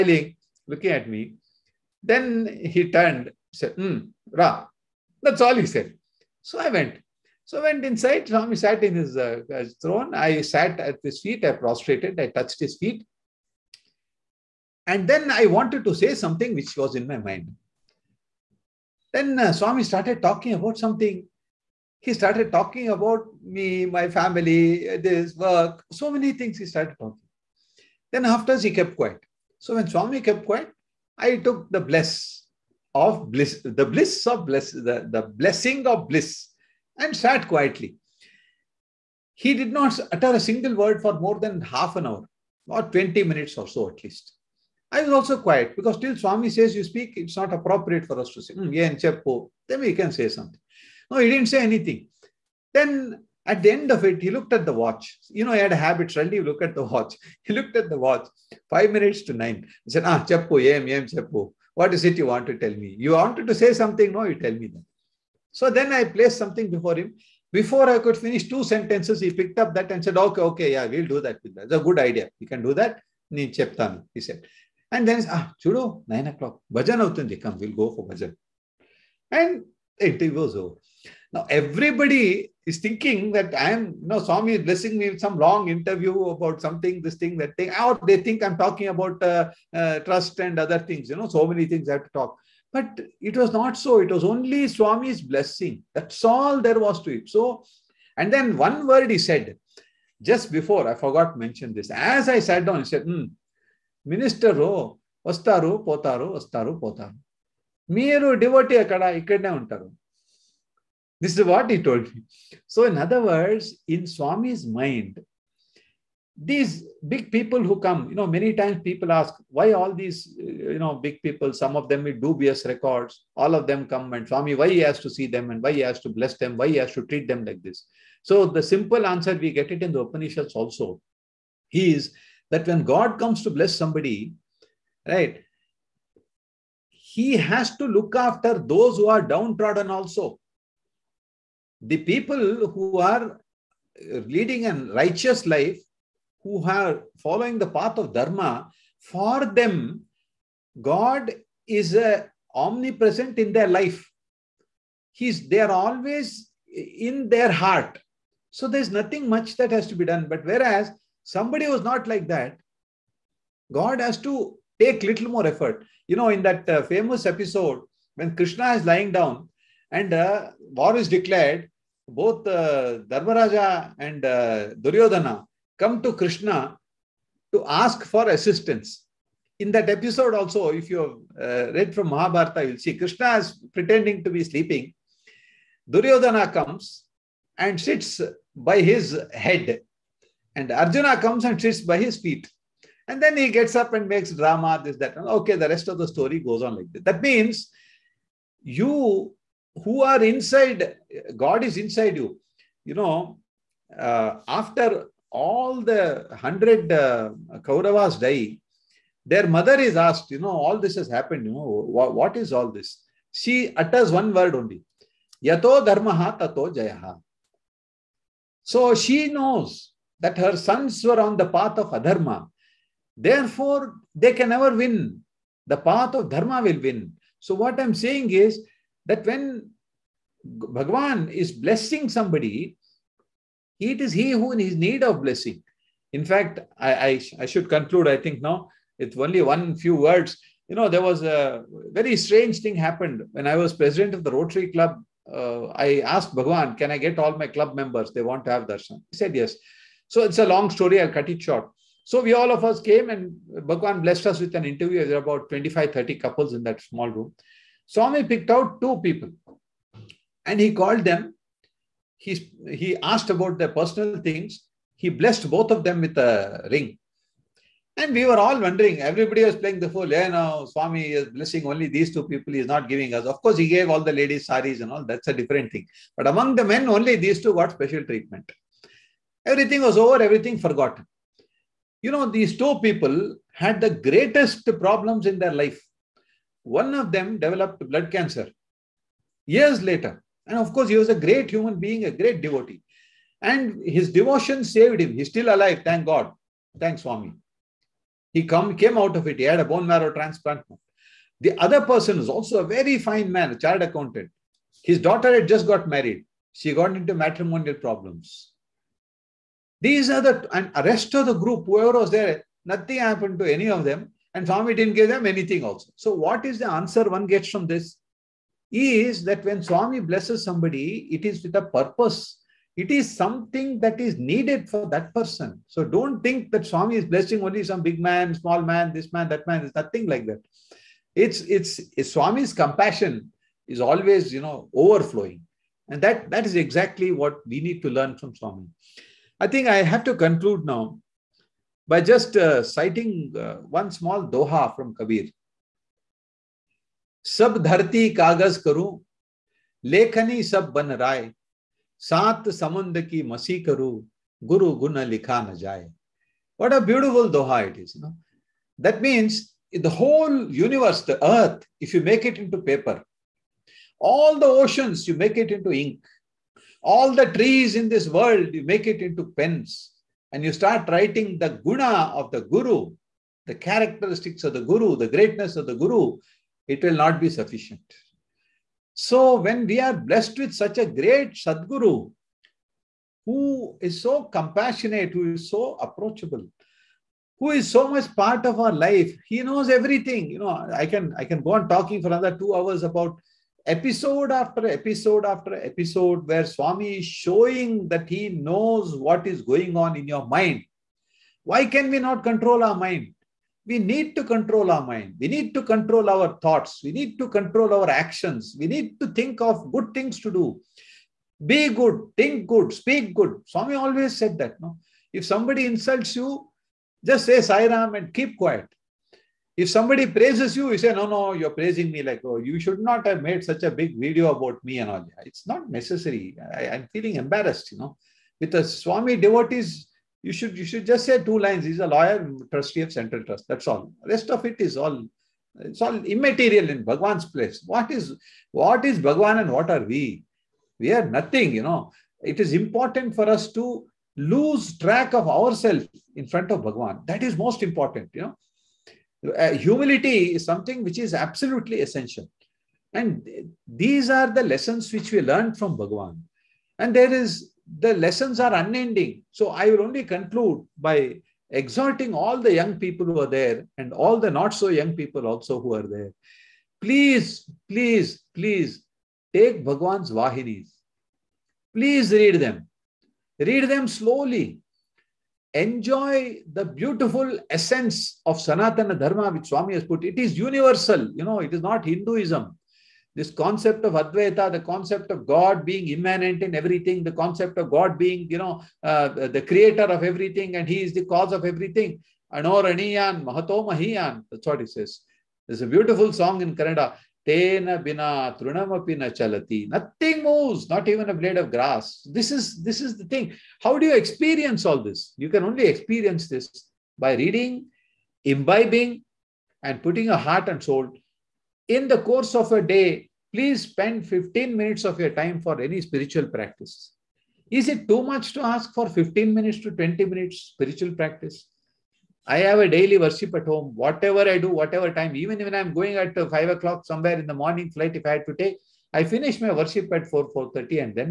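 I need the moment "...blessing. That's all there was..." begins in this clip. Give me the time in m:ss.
1:35.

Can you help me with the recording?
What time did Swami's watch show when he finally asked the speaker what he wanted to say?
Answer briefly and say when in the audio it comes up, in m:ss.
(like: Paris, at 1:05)
Five minutes to nine, at 0:58.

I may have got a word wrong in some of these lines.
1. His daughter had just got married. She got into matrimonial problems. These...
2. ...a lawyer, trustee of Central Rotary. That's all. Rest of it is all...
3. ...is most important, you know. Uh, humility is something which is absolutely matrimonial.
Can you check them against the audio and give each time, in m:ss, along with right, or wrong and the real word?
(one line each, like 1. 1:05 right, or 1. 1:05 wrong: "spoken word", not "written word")
1. 5:04 right
2. 7:11 wrong: "Trust", not "Rotary"
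3. 7:27 wrong: "essential", not "matrimonial".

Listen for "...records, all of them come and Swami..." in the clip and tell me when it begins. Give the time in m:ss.
2:02.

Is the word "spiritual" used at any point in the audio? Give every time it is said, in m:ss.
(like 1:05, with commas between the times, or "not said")
8:35, 8:40.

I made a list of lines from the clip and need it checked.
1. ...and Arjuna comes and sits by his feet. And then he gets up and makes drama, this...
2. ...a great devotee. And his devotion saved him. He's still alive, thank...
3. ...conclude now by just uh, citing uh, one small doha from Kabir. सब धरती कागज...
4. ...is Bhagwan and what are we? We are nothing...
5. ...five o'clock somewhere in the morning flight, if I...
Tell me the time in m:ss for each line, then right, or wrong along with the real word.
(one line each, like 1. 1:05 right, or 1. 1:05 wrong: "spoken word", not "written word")
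1. 3:10 right
2. 4:52 right
3. 5:40 right
4. 7:18 right
5. 8:46 right.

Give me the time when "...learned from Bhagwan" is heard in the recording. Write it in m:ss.
7:35.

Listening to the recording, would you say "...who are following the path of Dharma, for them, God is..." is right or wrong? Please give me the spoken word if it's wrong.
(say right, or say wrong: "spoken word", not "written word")
right.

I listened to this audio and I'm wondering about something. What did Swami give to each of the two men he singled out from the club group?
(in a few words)
A ring.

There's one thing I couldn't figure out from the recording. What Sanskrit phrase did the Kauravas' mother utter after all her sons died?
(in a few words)
Yato Dharmaha Tato Jayaha.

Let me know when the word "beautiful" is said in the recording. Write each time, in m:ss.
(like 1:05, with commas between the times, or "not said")
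5:56, 7:56, 8:15.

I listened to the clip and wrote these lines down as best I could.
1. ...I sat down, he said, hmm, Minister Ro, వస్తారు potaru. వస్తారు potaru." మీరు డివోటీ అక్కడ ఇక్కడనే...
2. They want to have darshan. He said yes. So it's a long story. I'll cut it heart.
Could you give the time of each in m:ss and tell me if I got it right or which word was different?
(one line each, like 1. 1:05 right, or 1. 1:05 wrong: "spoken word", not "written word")
1. 1:42 right
2. 4:08 wrong: "short", not "heart".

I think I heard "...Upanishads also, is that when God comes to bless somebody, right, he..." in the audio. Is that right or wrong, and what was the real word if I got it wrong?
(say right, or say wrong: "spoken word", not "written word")
right.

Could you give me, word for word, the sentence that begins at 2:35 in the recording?
He's, they are always in their heart.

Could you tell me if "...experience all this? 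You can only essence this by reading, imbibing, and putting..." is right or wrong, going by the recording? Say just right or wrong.
wrong.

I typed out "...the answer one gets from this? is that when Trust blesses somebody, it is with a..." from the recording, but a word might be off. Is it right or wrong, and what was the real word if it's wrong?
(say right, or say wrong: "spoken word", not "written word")
wrong: "Swami", not "Trust".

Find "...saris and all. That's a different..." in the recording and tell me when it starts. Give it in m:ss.
4:34.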